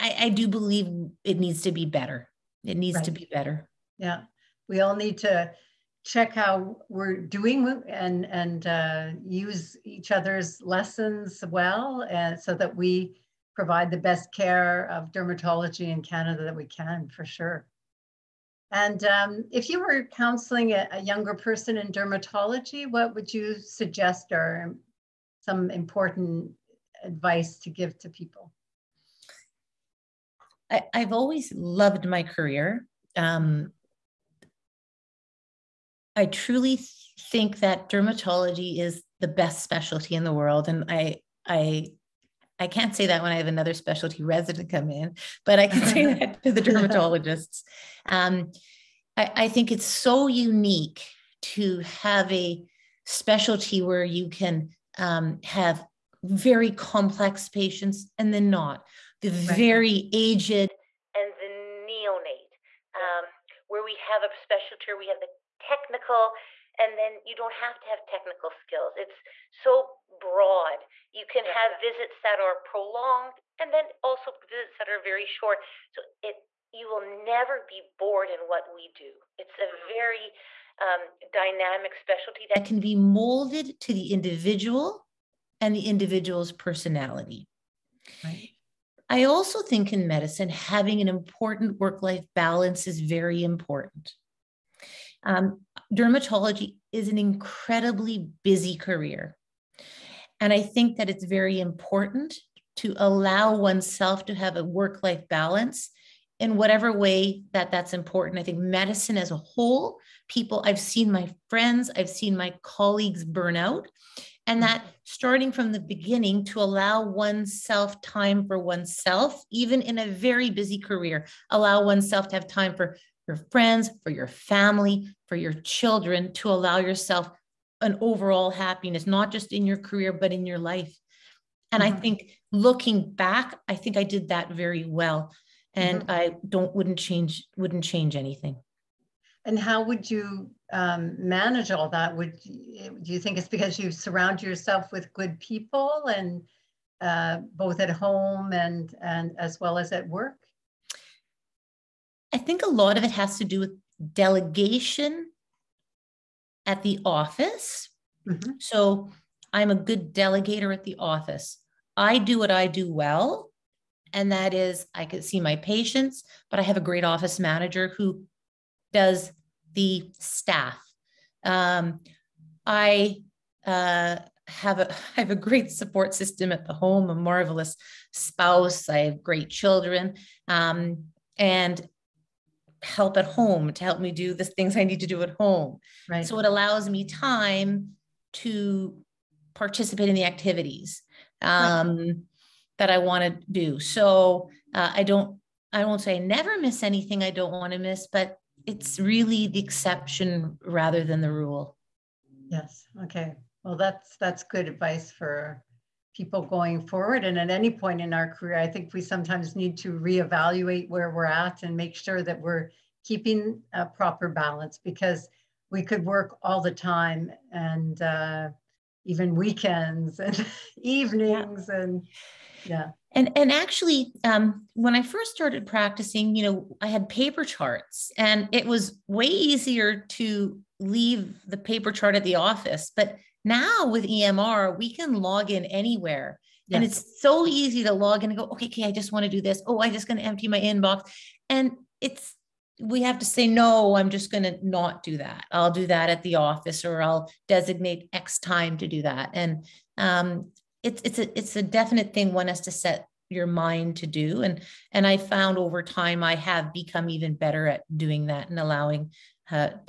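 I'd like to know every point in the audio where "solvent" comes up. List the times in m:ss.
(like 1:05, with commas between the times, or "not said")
not said.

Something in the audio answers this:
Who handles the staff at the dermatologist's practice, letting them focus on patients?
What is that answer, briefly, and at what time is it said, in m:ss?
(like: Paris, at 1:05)
office manager, at 2:47.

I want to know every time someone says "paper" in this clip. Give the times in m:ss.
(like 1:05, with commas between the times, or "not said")
3:47, 3:51.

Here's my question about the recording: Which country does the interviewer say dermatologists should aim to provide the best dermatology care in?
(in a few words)
Canada.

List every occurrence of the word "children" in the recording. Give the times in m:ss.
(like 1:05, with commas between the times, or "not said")
2:05, 2:59.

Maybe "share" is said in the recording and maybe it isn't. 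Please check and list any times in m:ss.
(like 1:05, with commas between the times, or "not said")
not said.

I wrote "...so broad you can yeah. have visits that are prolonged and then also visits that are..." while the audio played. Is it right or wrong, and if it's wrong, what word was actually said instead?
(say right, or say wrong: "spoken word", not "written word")
right.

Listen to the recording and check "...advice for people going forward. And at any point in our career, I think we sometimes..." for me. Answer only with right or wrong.
right.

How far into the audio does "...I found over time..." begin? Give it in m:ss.
4:15.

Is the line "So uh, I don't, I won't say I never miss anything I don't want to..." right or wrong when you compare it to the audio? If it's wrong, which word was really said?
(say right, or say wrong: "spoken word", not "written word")
right.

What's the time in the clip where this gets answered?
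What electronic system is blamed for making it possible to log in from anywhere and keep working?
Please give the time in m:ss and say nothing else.
3:54.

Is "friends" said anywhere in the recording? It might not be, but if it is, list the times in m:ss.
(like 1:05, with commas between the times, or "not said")
1:51, 2:03.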